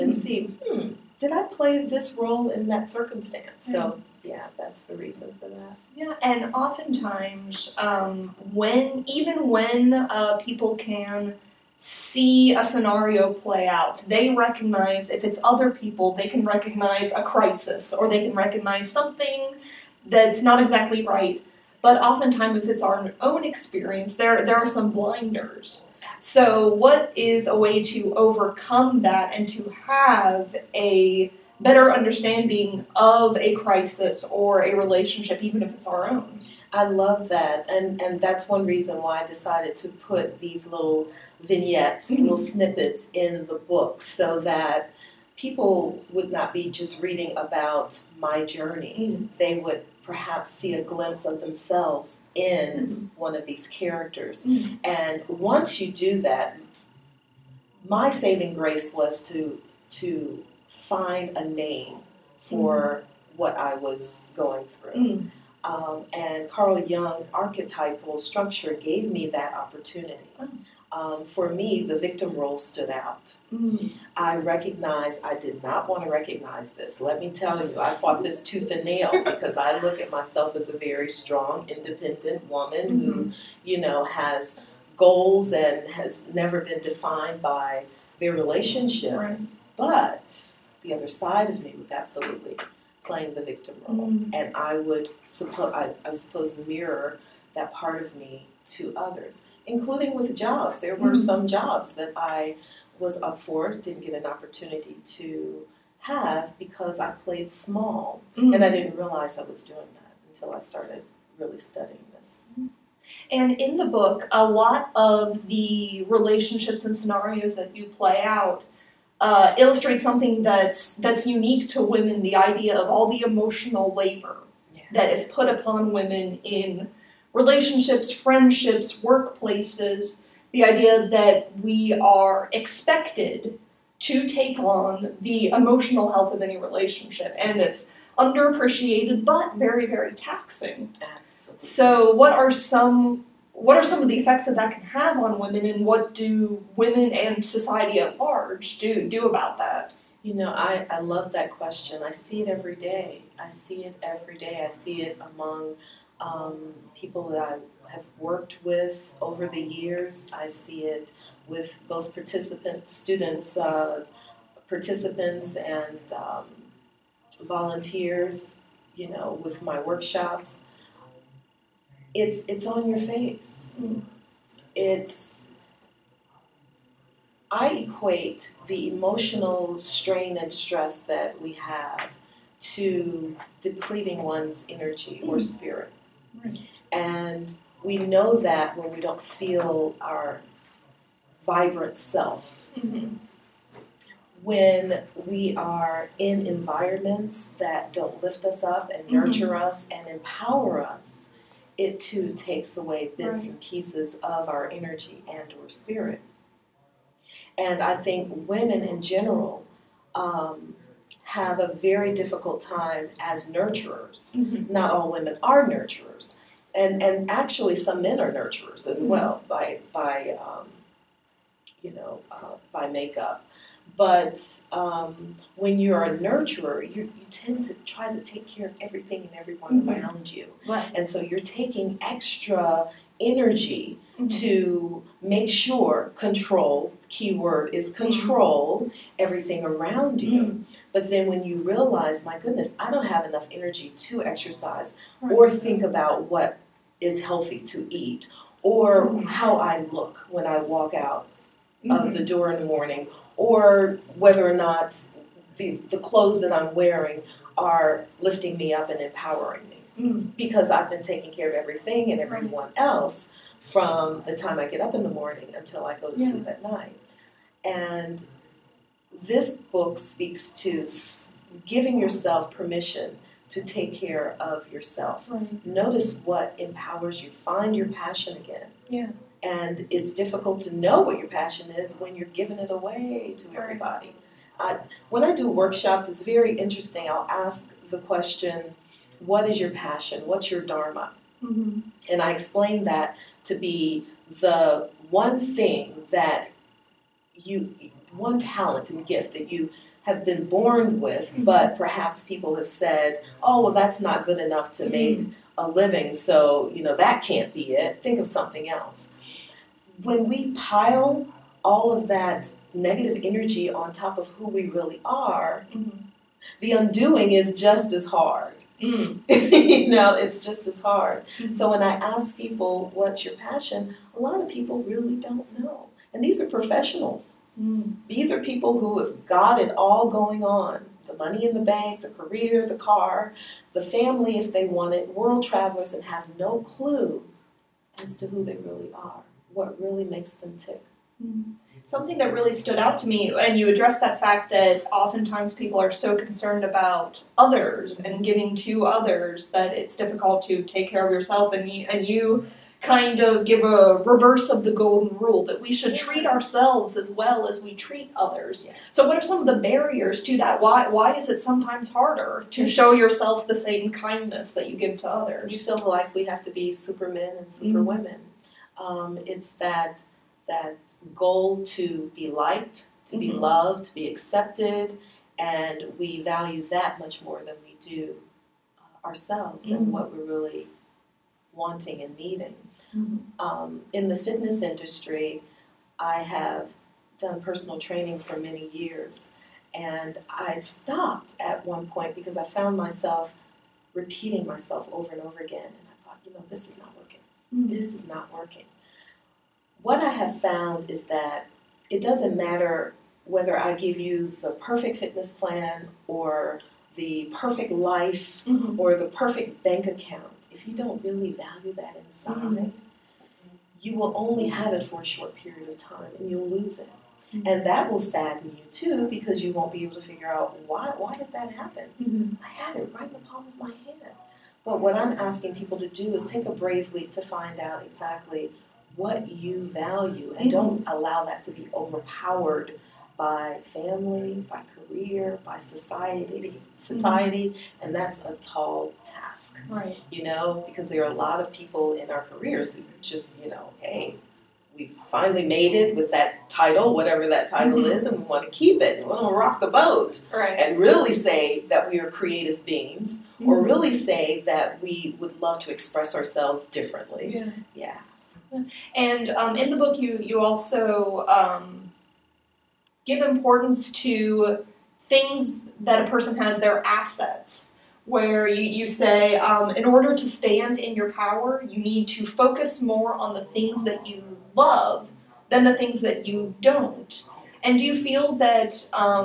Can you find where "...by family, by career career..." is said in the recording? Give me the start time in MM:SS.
07:13.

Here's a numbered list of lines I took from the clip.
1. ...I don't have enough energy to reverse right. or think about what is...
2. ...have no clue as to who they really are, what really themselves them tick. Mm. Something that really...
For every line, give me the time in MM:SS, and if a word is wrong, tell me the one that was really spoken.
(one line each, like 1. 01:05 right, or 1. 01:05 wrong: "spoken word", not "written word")
1. 04:02 wrong: "exercise", not "reverse"
2. 05:36 wrong: "makes", not "themselves".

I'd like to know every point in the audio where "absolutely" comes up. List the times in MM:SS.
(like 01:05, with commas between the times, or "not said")
01:31, 02:21.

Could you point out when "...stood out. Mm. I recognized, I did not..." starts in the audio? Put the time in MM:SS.
01:12.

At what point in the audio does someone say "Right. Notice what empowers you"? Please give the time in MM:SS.
04:35.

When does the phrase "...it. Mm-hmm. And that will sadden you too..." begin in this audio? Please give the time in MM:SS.
06:56.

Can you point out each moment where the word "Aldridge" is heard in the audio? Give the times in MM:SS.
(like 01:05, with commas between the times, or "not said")
not said.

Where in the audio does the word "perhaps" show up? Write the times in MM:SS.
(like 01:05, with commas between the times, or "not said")
00:50, 05:01.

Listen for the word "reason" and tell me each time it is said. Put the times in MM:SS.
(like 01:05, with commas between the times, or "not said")
00:04, 00:38.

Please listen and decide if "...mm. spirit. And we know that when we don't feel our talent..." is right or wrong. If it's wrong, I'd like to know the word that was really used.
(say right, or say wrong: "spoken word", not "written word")
wrong: "vibrant", not "talent".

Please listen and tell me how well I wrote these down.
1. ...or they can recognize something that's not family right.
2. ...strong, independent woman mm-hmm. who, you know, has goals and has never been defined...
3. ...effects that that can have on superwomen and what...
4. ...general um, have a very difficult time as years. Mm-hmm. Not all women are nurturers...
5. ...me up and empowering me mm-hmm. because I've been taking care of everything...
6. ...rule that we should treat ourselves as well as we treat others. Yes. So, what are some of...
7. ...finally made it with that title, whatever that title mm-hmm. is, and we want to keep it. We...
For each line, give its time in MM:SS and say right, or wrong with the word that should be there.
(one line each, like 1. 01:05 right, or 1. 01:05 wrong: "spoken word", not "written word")
1. 00:17 wrong: "exactly", not "family"
2. 01:21 right
3. 02:24 wrong: "women", not "superwomen"
4. 03:29 wrong: "nurturers", not "years"
5. 04:18 right
6. 05:55 right
7. 07:25 right.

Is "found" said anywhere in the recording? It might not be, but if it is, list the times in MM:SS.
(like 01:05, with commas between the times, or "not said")
06:32, 06:40.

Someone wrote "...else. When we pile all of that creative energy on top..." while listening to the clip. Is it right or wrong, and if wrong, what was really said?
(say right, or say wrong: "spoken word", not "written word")
wrong: "negative", not "creative".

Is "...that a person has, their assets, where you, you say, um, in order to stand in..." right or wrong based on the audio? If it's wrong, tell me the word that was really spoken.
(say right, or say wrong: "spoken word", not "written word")
right.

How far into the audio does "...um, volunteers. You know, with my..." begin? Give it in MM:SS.
02:46.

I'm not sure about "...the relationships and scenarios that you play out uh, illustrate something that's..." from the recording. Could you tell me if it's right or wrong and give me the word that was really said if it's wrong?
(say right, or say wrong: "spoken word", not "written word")
right.